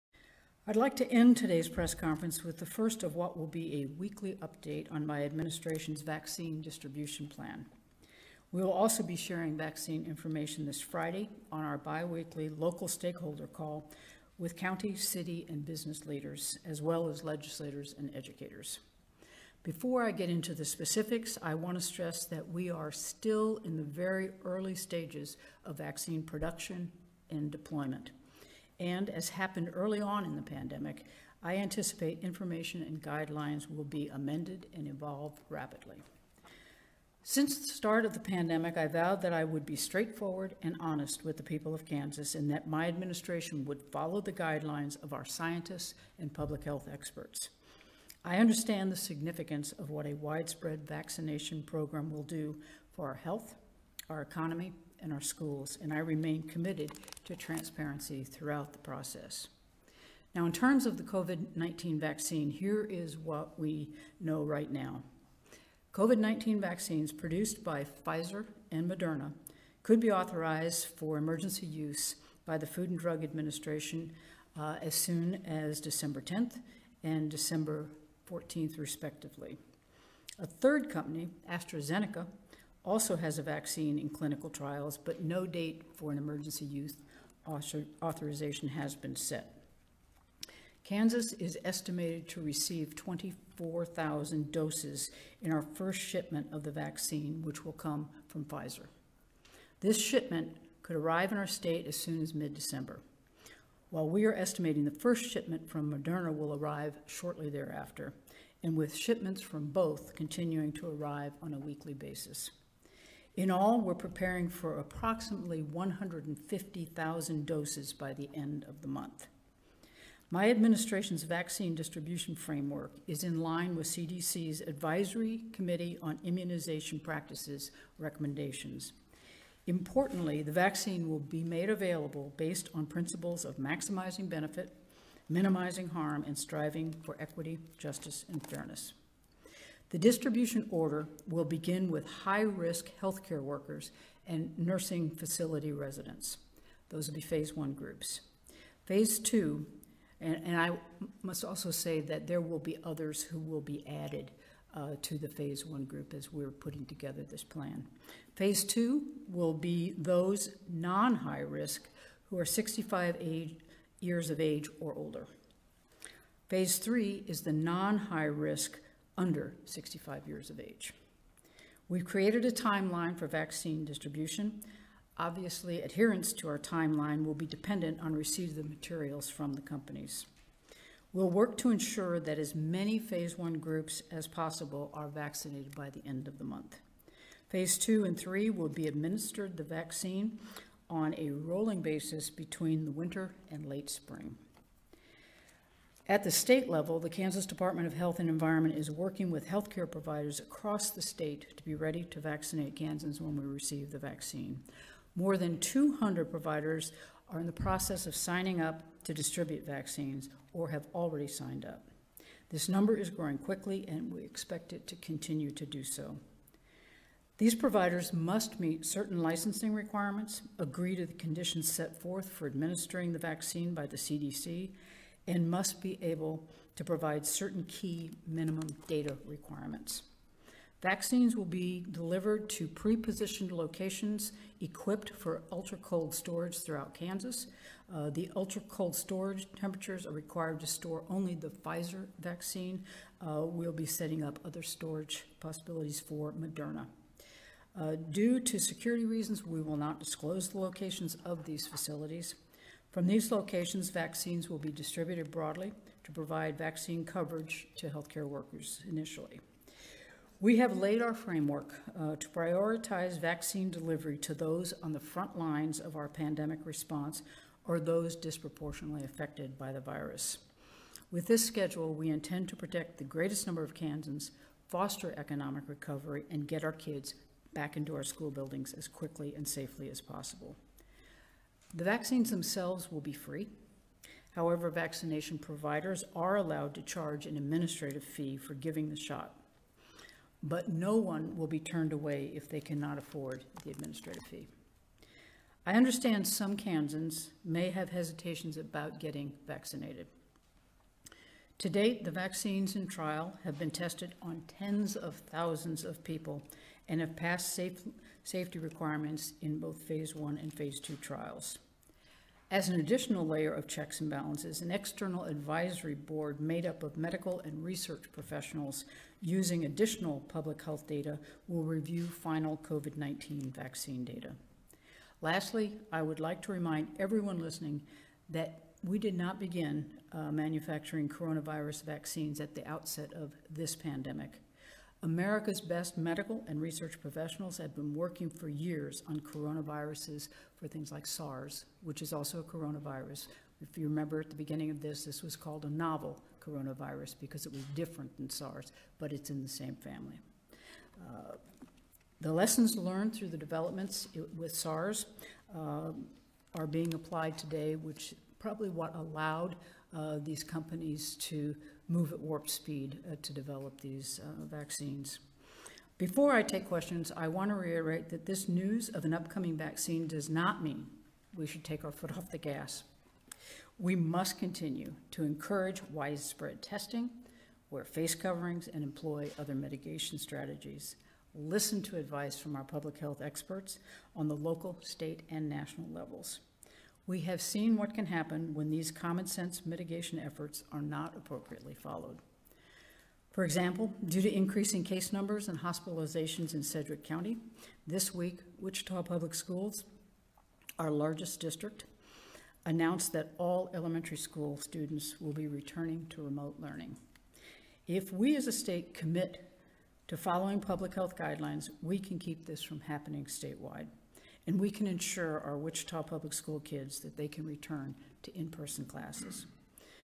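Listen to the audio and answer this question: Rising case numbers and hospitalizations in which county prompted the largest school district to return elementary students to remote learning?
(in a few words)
Sedgwick County.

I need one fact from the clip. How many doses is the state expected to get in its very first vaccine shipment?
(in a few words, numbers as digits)
24,000.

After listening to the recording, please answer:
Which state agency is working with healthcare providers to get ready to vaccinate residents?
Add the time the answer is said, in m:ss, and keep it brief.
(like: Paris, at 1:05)
Kansas Department of Health and Environment, at 3:17.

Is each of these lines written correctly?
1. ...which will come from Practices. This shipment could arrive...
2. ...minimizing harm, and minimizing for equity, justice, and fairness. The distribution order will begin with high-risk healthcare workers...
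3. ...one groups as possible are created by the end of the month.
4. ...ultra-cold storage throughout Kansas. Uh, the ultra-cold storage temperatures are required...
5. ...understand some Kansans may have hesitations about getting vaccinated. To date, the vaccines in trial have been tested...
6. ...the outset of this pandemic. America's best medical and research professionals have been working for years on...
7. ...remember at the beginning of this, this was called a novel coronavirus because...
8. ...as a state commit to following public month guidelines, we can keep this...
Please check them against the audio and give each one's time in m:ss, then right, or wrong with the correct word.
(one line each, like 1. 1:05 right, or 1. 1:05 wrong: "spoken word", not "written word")
1. 1:37 wrong: "Pfizer", not "Practices"
2. 2:15 wrong: "striving", not "minimizing"
3. 3:03 wrong: "vaccinated", not "created"
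4. 3:55 right
5. 4:55 right
6. 5:32 right
7. 5:43 right
8. 6:48 wrong: "health", not "month".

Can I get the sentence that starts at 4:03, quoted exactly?
Uh, we'll be setting up other storage possibilities for Moderna.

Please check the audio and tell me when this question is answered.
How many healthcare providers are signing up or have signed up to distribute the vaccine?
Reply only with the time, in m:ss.
3:25.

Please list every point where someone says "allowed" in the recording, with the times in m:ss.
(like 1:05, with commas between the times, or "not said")
4:46, 5:58.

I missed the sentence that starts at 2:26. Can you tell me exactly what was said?
Those will be phase one groups.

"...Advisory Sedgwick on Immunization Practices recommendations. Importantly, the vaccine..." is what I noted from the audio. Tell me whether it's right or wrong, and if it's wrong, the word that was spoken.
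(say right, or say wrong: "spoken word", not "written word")
wrong: "Committee", not "Sedgwick".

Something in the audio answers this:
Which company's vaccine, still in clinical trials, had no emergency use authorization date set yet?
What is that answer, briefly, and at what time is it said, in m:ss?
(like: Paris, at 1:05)
AstraZeneca, at 1:21.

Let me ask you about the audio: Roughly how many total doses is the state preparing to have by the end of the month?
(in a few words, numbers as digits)
150,000.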